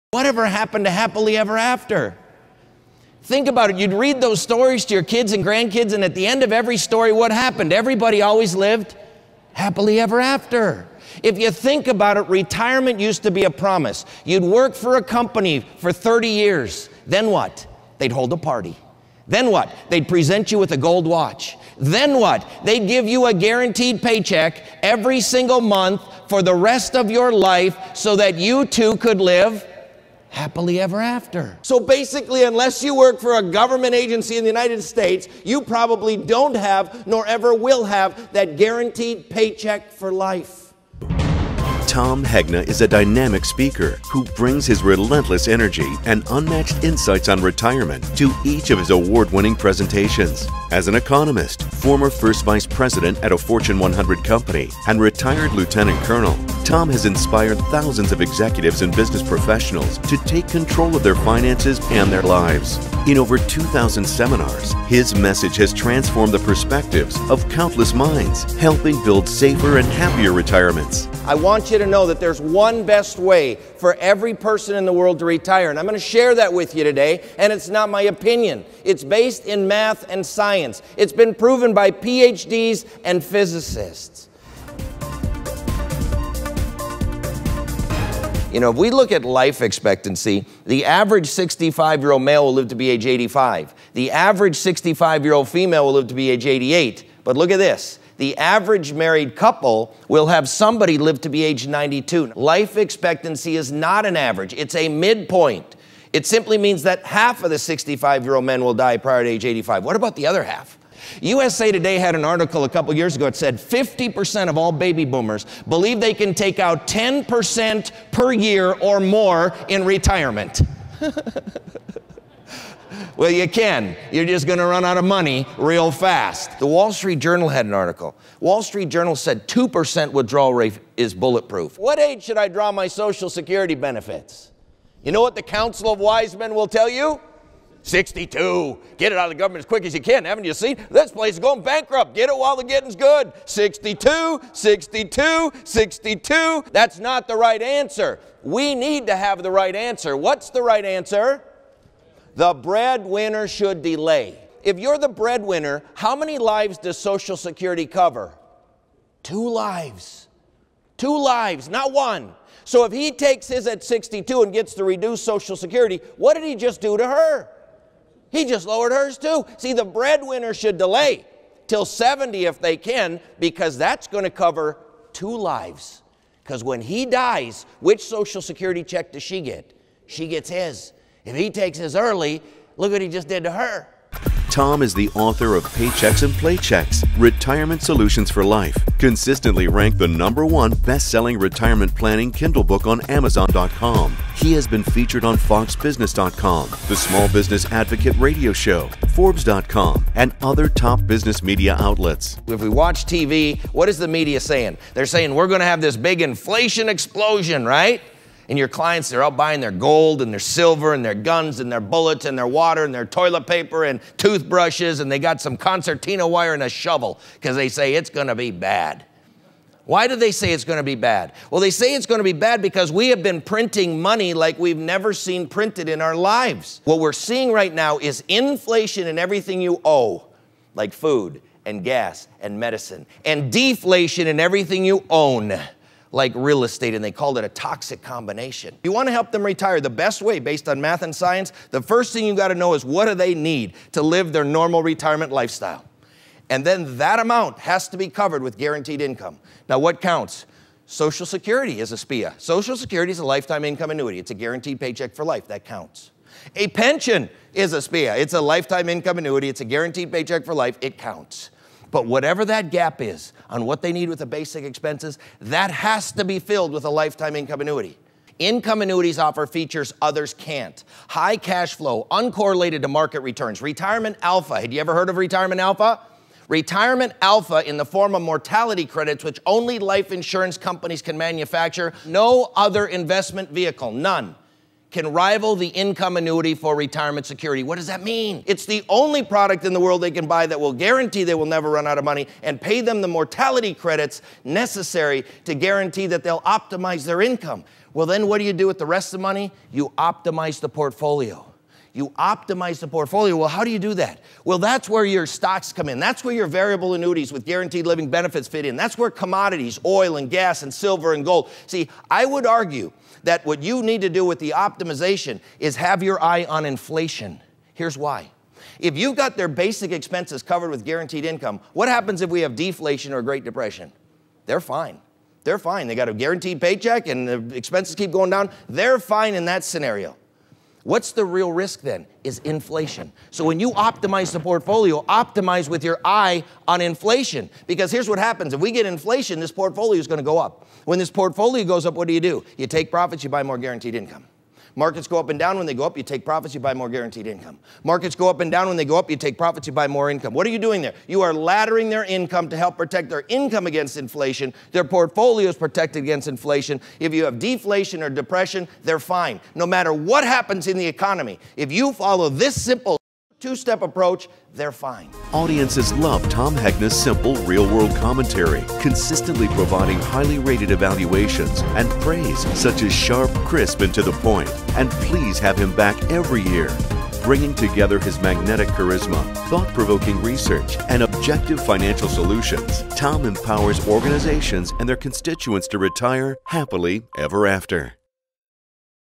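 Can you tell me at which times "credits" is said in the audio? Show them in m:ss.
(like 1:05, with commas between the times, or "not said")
4:38, 4:53.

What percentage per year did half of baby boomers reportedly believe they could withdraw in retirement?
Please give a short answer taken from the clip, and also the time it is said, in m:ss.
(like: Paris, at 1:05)
10%, at 1:56.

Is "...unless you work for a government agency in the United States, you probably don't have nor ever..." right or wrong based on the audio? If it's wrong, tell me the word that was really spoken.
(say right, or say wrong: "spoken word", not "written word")
right.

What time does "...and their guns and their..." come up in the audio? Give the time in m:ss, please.
3:30.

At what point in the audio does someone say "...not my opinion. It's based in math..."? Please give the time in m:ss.
1:17.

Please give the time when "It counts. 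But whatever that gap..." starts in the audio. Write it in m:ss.
4:20.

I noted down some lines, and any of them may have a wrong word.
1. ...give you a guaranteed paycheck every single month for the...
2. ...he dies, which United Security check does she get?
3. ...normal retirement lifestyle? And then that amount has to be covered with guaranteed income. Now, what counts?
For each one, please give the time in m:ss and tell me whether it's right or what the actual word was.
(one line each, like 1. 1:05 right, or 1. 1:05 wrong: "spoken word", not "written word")
1. 0:22 right
2. 2:56 wrong: "Social", not "United"
3. 4:04 right.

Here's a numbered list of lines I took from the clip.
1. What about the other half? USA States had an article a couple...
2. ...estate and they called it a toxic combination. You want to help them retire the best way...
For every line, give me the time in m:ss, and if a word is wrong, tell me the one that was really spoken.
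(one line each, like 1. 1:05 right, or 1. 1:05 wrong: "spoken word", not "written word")
1. 1:49 wrong: "Today", not "States"
2. 3:56 right.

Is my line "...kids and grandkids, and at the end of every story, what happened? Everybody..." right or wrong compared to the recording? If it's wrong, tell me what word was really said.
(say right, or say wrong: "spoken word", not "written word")
right.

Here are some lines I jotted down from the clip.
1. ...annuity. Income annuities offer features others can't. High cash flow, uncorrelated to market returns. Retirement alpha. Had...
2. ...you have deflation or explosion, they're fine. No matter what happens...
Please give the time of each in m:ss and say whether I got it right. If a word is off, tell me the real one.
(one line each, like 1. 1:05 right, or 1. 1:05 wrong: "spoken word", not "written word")
1. 4:27 right
2. 5:57 wrong: "depression", not "explosion".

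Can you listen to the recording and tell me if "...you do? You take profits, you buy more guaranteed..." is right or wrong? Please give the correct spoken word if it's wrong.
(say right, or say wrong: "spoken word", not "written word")
right.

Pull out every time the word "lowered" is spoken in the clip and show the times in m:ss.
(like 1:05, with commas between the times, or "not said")
2:48.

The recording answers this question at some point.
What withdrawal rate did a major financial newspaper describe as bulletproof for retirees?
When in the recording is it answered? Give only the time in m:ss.
2:09.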